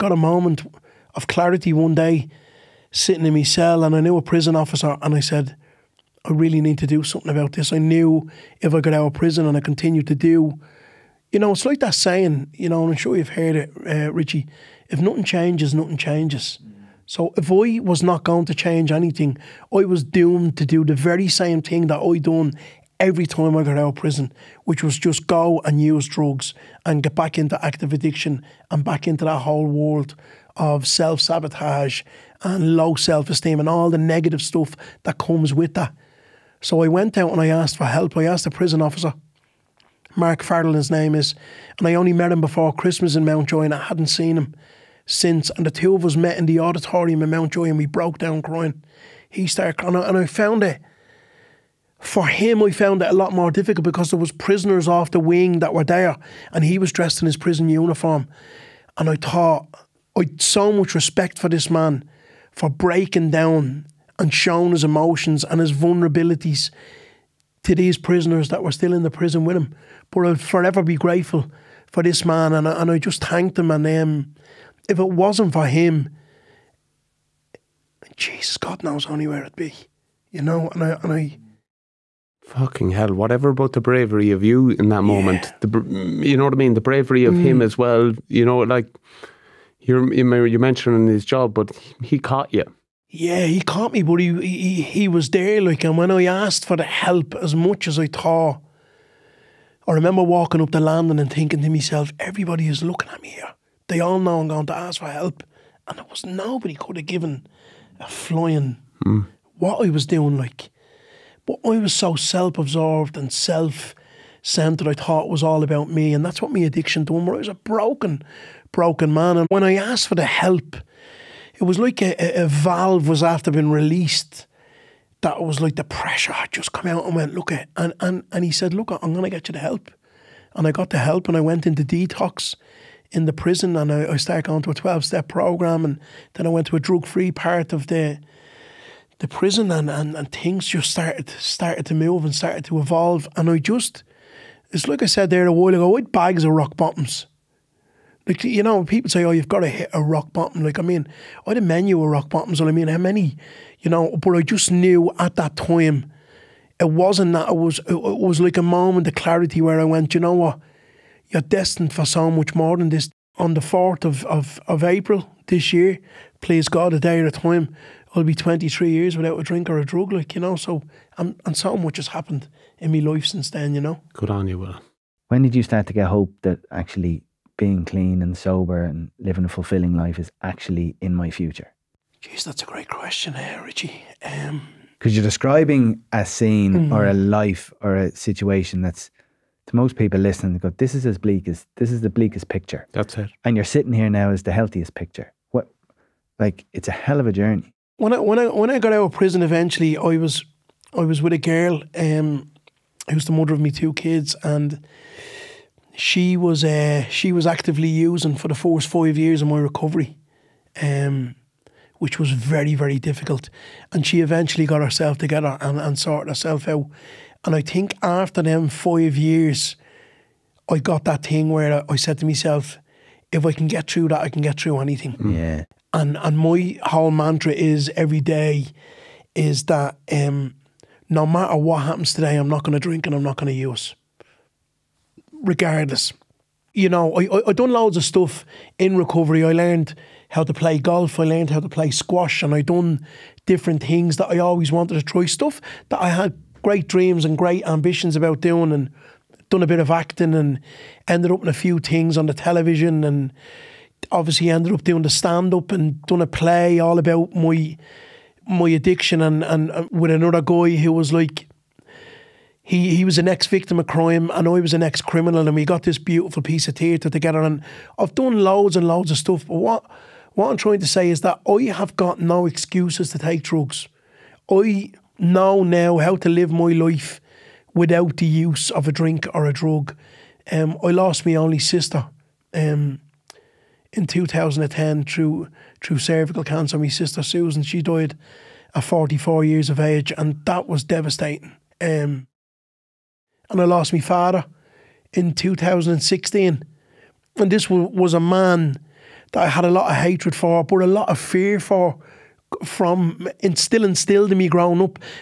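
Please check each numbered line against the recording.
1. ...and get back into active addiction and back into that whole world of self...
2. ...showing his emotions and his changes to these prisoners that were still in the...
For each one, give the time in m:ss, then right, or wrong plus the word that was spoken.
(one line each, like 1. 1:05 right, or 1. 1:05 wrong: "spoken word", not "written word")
1. 0:26 right
2. 1:04 wrong: "vulnerabilities", not "changes".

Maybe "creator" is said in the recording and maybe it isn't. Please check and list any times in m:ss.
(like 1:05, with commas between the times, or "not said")
not said.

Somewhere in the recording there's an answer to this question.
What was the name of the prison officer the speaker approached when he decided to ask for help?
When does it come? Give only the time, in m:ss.
0:40.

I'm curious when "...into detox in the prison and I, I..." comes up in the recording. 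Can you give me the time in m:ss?
2:11.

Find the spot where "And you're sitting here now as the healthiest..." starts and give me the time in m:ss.
3:13.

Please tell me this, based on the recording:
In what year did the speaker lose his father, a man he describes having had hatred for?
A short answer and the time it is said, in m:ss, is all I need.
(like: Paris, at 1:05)
2016, at 4:55.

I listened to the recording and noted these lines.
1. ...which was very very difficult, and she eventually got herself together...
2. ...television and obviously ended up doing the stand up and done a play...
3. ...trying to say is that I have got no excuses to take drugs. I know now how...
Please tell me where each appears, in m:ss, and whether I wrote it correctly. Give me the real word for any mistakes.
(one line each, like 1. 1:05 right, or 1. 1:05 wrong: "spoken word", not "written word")
1. 3:31 right
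2. 4:12 right
3. 4:30 right.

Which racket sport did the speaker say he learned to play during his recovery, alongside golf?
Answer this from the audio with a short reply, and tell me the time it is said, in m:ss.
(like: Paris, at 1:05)
Squash, at 4:01.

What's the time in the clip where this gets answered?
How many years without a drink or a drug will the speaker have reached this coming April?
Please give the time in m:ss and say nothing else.
2:48.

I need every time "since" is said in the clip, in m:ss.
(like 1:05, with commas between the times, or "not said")
0:45, 2:53.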